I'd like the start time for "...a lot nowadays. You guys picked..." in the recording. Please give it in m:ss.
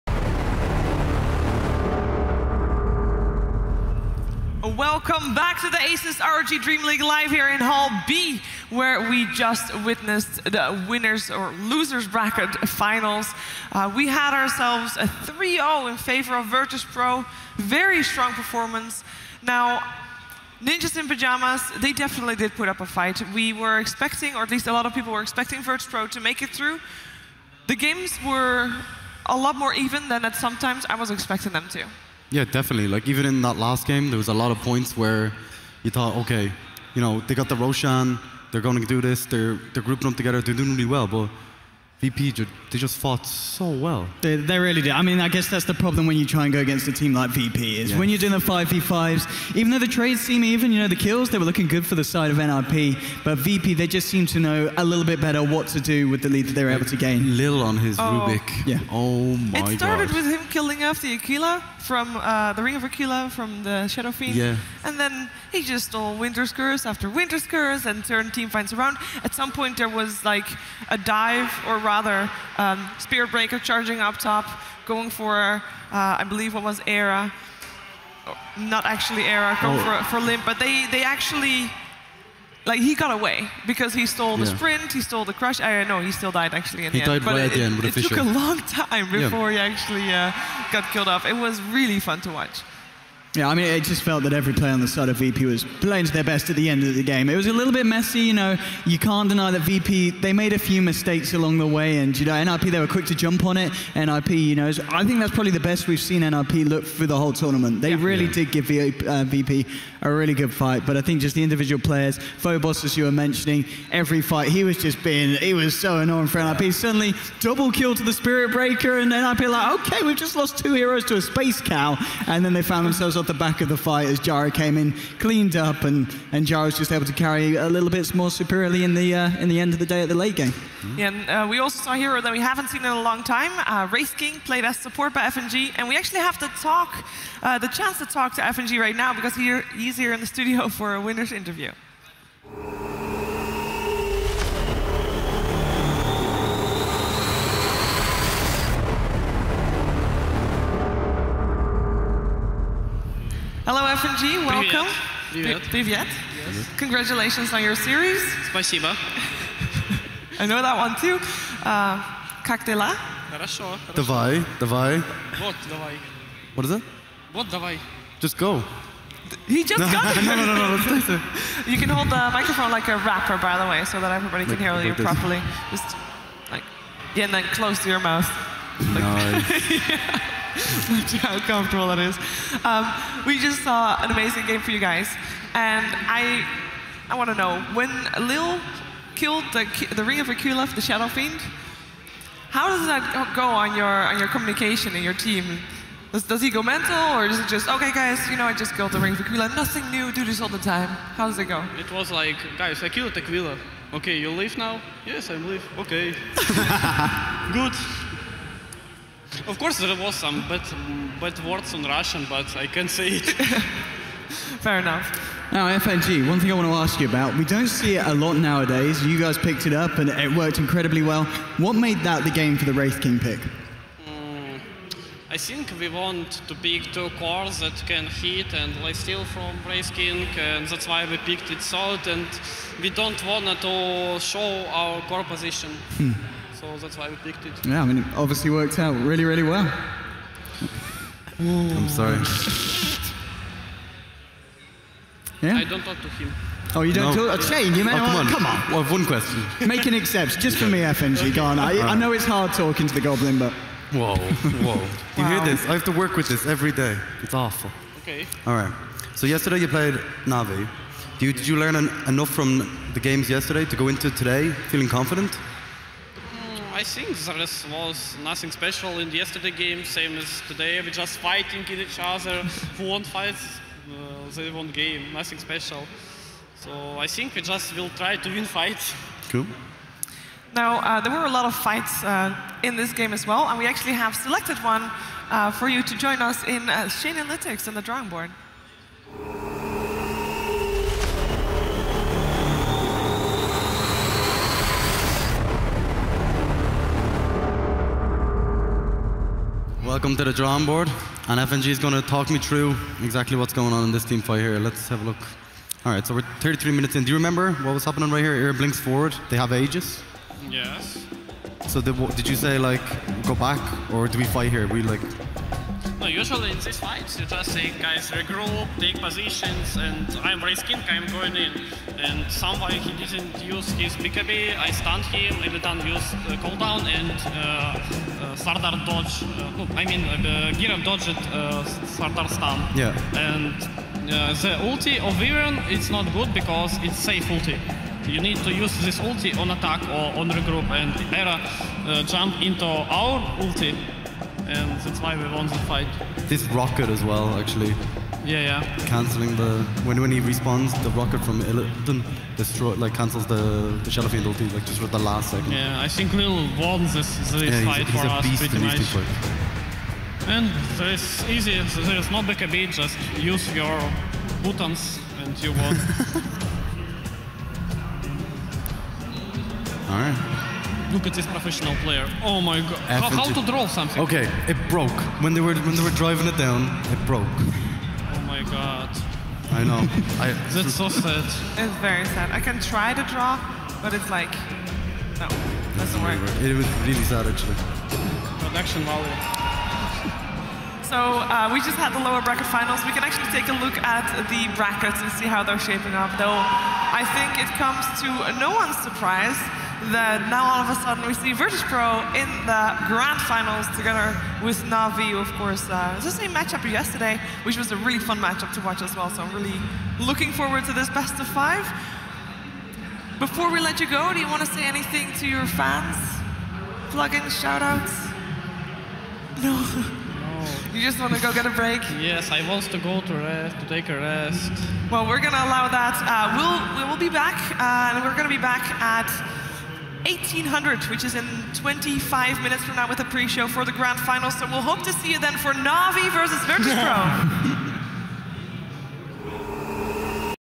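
3:38.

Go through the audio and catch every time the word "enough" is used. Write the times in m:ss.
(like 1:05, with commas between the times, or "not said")
3:34, 4:22.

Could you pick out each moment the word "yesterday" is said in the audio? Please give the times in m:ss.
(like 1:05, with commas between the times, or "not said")
4:19, 4:23, 4:29, 6:46.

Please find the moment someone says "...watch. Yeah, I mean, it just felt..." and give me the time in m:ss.
1:32.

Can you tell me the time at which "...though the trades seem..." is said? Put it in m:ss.
0:49.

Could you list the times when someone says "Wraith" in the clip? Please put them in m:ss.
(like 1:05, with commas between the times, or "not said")
2:13, 3:42, 3:49.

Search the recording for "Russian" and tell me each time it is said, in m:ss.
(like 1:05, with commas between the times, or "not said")
3:31.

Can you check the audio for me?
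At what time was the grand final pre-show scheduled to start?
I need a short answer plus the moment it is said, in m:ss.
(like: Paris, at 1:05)
1800, at 7:10.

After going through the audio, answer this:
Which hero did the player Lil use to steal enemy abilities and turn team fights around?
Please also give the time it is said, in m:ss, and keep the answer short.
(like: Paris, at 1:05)
Rubik, at 0:58.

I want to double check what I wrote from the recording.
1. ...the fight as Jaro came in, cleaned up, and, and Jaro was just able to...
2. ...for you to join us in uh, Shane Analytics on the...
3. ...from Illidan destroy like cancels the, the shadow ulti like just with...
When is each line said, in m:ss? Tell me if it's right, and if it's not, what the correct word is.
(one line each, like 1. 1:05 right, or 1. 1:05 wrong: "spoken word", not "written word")
1. 2:03 right
2. 4:45 right
3. 5:51 right.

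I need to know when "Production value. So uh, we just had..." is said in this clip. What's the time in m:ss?
6:28.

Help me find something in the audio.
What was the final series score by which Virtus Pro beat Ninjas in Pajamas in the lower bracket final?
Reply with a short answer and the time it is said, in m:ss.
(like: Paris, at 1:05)
3-0, at 0:15.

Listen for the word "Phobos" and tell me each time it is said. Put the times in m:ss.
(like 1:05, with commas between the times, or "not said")
1:52.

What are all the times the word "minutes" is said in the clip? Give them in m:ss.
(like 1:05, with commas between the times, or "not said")
5:06, 7:12.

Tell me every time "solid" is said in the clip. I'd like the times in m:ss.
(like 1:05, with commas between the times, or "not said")
3:51.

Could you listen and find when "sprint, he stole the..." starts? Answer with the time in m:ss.
1:24.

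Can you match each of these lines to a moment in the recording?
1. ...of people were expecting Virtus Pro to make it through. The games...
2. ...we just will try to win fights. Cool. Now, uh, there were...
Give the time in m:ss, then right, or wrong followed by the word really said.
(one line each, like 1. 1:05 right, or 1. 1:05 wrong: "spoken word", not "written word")
1. 0:24 right
2. 4:37 right.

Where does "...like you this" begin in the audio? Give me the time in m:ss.
2:54.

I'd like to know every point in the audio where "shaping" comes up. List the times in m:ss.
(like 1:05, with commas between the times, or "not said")
6:35.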